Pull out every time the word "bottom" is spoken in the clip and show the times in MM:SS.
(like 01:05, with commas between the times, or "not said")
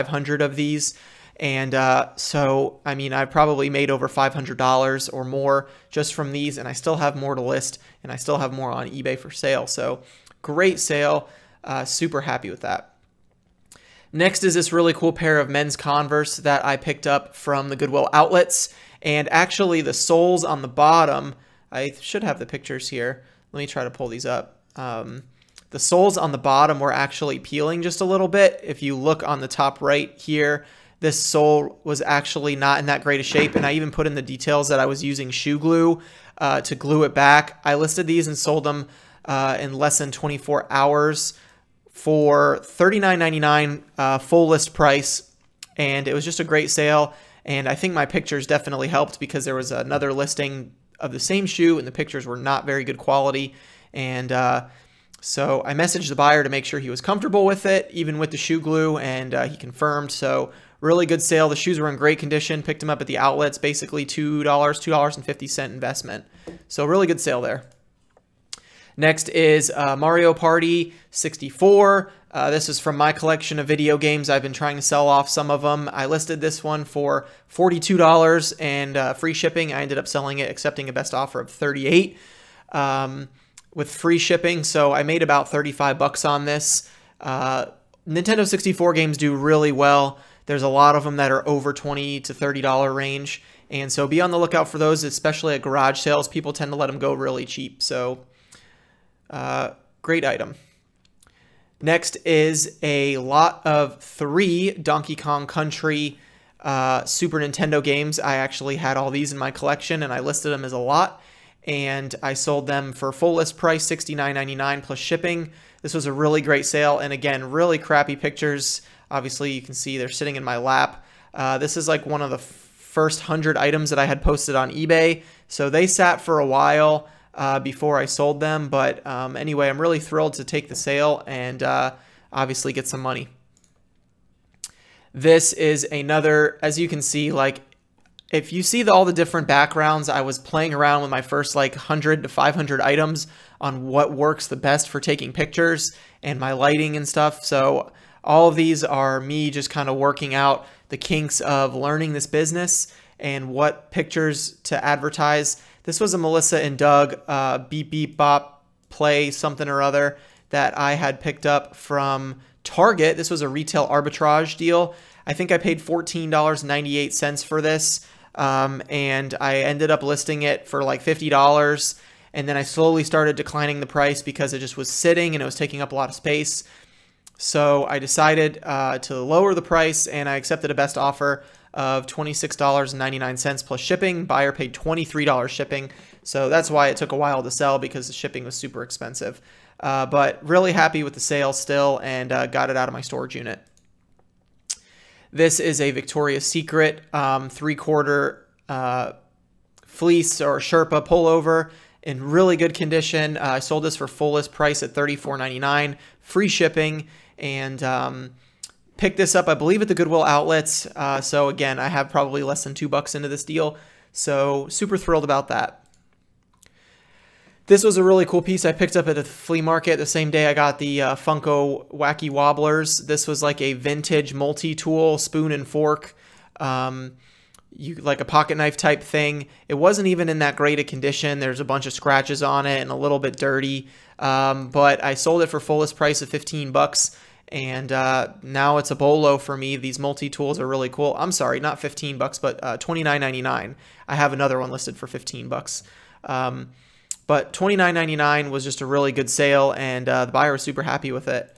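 00:20, 00:26.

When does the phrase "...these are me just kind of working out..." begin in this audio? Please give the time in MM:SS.
02:28.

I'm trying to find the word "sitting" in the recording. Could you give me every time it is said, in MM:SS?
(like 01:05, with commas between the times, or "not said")
02:00, 02:54.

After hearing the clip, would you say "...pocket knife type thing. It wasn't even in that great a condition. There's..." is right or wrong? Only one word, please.
right.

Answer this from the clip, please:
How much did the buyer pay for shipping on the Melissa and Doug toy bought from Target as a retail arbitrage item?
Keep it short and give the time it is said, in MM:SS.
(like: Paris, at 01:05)
$23, at 03:04.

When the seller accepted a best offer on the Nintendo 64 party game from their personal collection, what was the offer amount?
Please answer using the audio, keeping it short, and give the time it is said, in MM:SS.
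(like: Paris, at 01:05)
38, at 01:21.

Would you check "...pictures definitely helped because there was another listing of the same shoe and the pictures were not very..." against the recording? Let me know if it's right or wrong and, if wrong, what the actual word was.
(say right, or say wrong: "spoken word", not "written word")
right.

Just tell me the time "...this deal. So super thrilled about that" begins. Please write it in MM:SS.
03:33.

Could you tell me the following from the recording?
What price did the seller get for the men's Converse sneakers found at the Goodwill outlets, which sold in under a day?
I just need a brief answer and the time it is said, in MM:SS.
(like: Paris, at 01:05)
$39.99, at 00:42.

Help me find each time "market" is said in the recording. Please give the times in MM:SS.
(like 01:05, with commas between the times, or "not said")
03:39.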